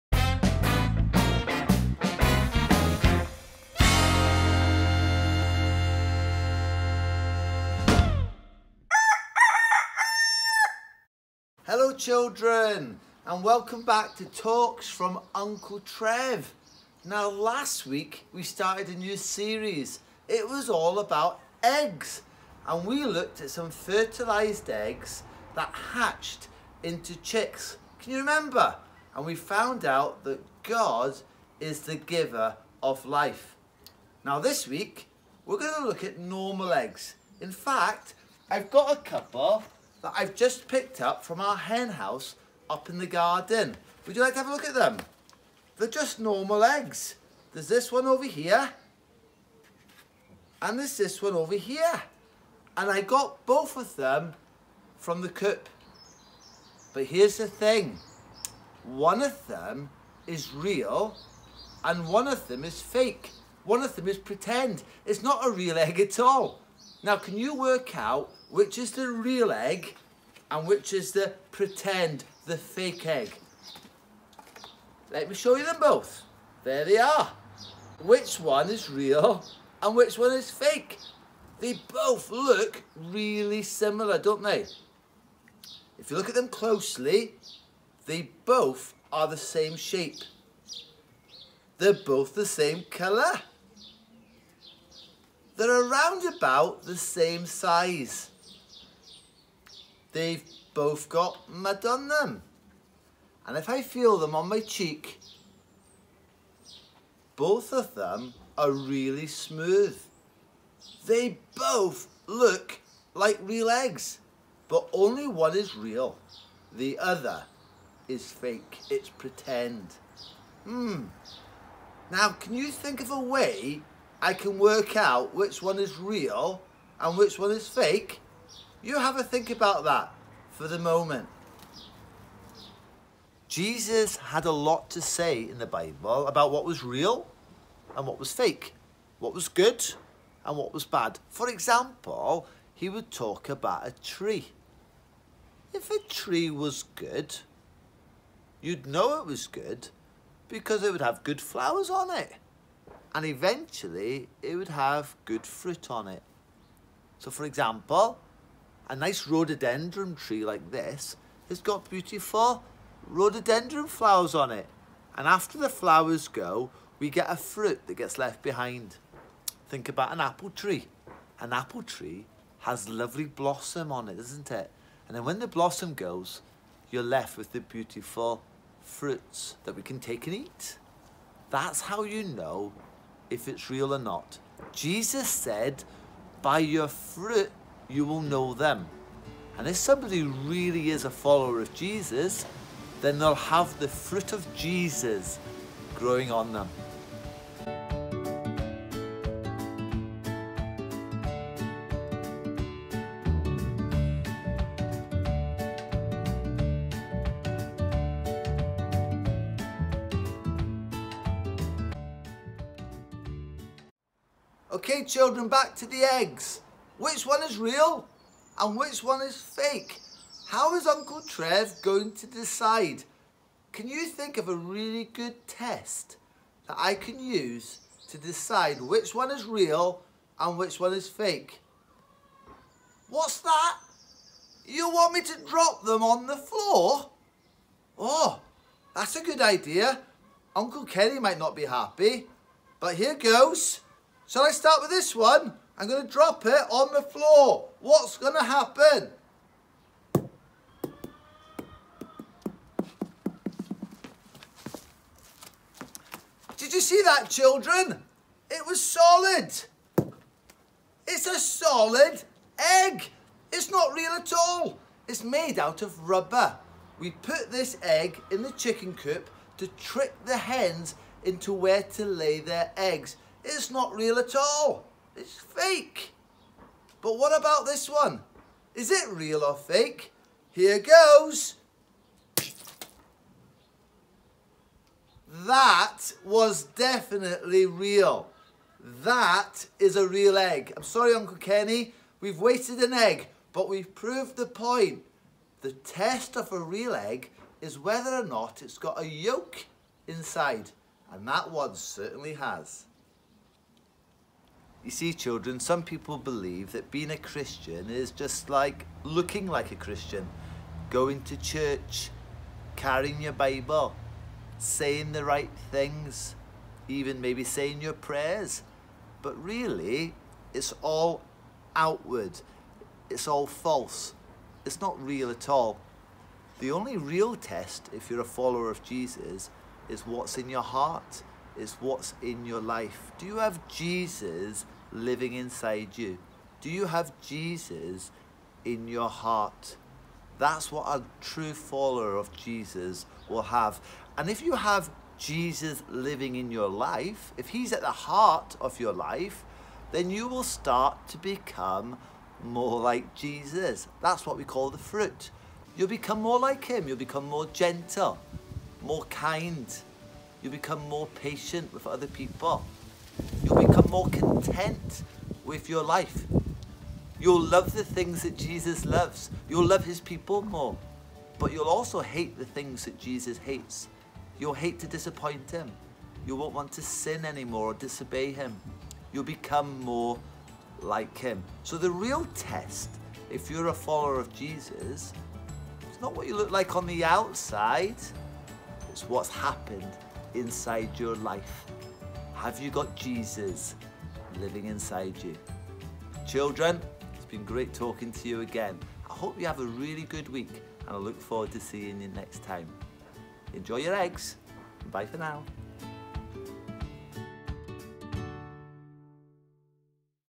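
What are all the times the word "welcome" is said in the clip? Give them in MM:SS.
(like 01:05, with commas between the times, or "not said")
00:13.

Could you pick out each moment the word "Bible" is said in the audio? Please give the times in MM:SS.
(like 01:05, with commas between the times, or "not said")
02:15, 05:13.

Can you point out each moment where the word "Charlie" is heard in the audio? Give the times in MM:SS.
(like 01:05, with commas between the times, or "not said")
not said.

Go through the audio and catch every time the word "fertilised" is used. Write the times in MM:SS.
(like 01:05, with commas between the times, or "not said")
00:23.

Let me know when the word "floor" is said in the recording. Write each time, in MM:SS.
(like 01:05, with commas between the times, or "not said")
03:56, 04:07.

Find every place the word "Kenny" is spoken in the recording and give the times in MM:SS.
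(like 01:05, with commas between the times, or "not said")
04:00, 04:51.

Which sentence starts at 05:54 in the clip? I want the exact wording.
That's what we call the fruit.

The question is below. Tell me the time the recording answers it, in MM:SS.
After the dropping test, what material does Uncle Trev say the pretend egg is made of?
04:26.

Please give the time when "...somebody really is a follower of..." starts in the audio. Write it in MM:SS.
03:09.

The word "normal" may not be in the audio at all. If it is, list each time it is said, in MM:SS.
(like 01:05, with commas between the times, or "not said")
00:36, 00:46.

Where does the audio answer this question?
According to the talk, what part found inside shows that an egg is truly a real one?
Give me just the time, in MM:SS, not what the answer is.
04:59.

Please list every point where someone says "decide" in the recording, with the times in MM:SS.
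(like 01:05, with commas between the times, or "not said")
03:42, 03:48.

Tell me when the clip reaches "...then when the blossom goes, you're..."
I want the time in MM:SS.
02:55.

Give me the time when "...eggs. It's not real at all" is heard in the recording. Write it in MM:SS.
04:32.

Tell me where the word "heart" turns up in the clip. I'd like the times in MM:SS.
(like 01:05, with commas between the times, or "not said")
05:30, 05:39, 05:48.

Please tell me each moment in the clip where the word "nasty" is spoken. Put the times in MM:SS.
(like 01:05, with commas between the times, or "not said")
not said.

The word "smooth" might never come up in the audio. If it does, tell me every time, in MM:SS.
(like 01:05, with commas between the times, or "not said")
01:49.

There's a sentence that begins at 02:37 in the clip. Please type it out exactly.
So for example, a nice rhododendron tree like this has got beautiful rhododendron flowers on it.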